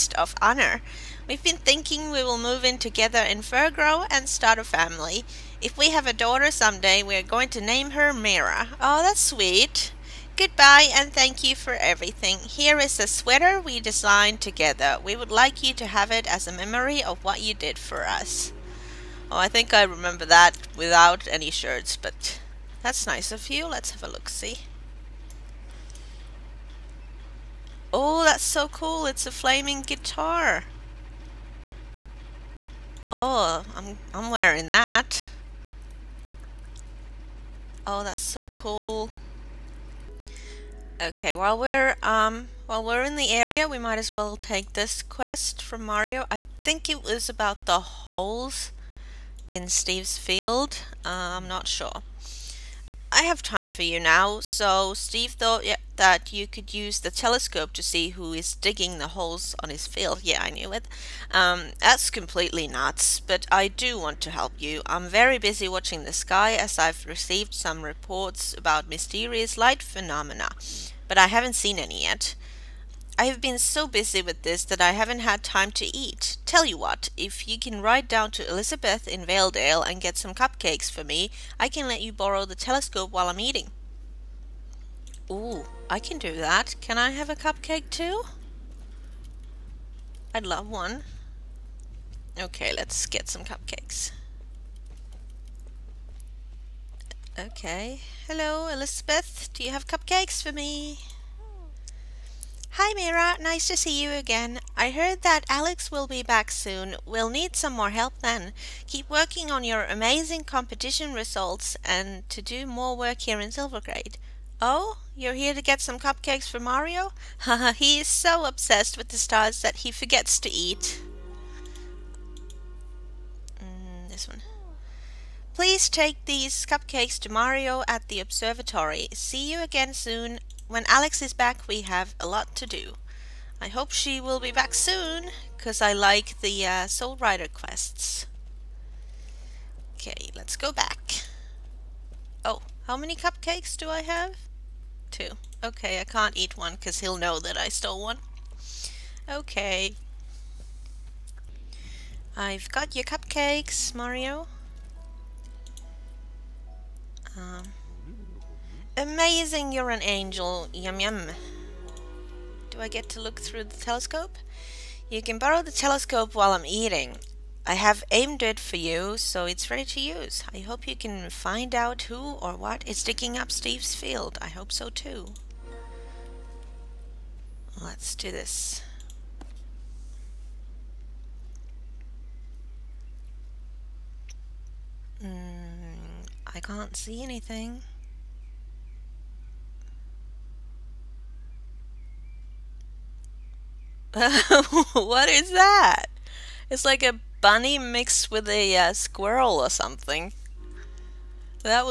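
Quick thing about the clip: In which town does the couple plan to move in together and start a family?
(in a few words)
Firgrove.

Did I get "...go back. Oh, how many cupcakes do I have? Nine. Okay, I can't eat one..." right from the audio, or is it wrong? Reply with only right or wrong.
wrong.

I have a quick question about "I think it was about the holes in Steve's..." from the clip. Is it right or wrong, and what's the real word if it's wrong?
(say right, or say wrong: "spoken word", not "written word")
right.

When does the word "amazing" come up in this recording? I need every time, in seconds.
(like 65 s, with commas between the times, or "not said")
109 s, 158 s.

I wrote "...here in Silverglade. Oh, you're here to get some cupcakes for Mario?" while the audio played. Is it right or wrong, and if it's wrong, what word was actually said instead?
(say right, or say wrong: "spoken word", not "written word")
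right.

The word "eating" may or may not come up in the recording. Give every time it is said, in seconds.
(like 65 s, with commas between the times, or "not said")
83 s, 166 s.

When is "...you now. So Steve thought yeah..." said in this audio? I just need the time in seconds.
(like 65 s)
53 s.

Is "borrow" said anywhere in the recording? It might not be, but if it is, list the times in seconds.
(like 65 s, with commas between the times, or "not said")
82 s, 165 s.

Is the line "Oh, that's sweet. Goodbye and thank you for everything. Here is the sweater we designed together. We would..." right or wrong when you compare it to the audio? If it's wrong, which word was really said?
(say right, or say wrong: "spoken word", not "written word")
right.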